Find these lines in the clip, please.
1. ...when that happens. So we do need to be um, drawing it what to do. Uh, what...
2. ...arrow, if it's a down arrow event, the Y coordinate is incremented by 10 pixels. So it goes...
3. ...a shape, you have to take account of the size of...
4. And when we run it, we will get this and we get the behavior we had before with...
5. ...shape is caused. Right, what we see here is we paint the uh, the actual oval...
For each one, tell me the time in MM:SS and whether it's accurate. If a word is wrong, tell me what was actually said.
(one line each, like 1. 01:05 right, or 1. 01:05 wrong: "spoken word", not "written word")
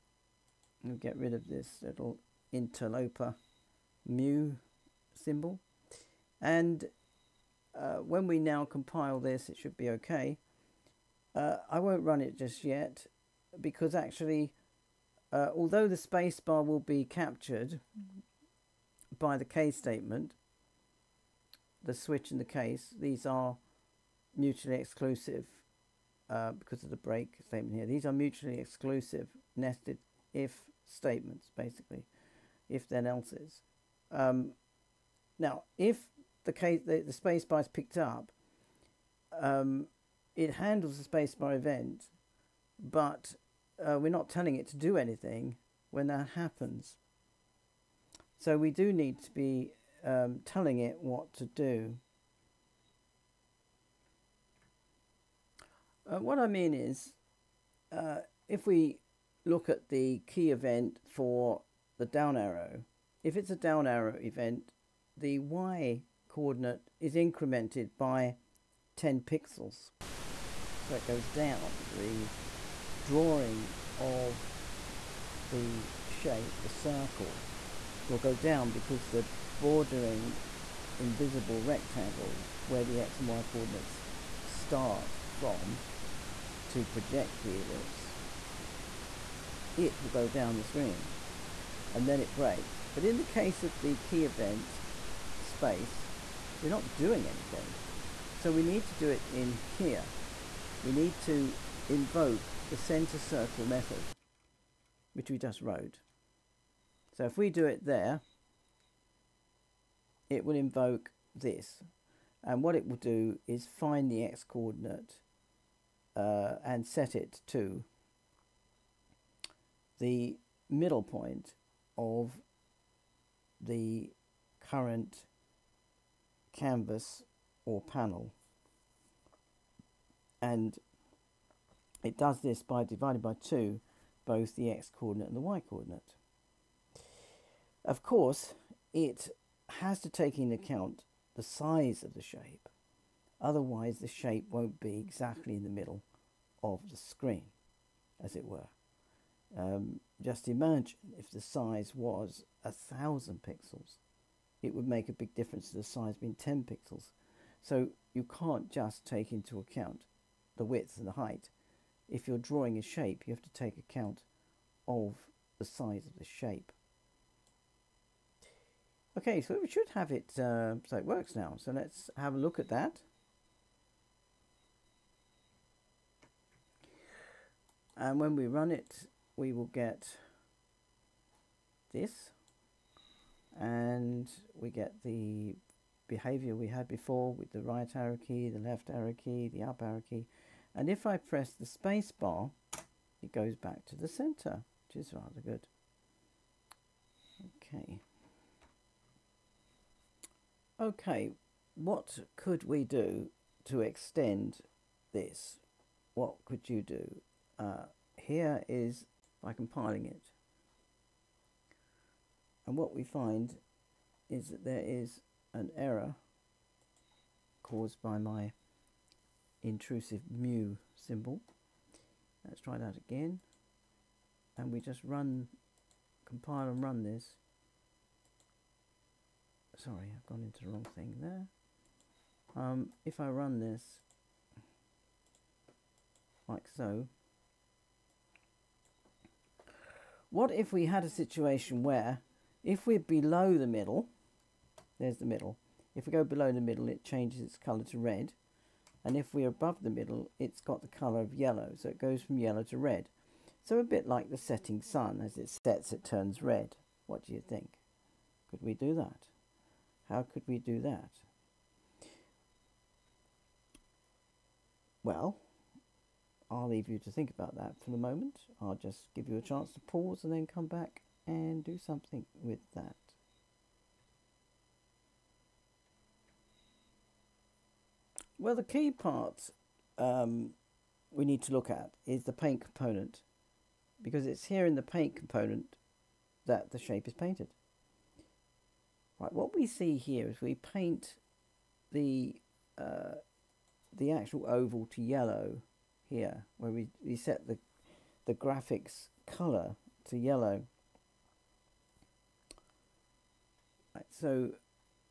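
1. 00:45 wrong: "telling", not "drawing"
2. 01:02 right
3. 02:42 right
4. 02:57 right
5. 04:46 wrong: "painted", not "caused".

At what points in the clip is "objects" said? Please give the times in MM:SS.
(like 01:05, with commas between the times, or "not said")
not said.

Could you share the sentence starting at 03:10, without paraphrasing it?
And if I press the space bar, it goes back to the center, which is rather good.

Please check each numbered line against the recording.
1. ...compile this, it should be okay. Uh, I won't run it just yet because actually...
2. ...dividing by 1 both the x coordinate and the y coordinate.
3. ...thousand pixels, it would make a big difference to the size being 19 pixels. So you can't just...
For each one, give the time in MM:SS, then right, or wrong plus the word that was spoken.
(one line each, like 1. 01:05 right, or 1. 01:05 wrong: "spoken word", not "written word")
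1. 00:08 right
2. 02:12 wrong: "2", not "1"
3. 02:32 wrong: "10", not "19".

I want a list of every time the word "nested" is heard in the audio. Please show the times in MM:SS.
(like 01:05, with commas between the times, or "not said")
00:29.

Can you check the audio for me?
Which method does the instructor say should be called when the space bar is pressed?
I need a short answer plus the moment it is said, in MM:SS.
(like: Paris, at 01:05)
center circle, at 01:42.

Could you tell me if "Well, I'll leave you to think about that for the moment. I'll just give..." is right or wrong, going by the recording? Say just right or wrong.
right.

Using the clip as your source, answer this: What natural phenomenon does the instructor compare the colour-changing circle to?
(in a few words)
the setting sun.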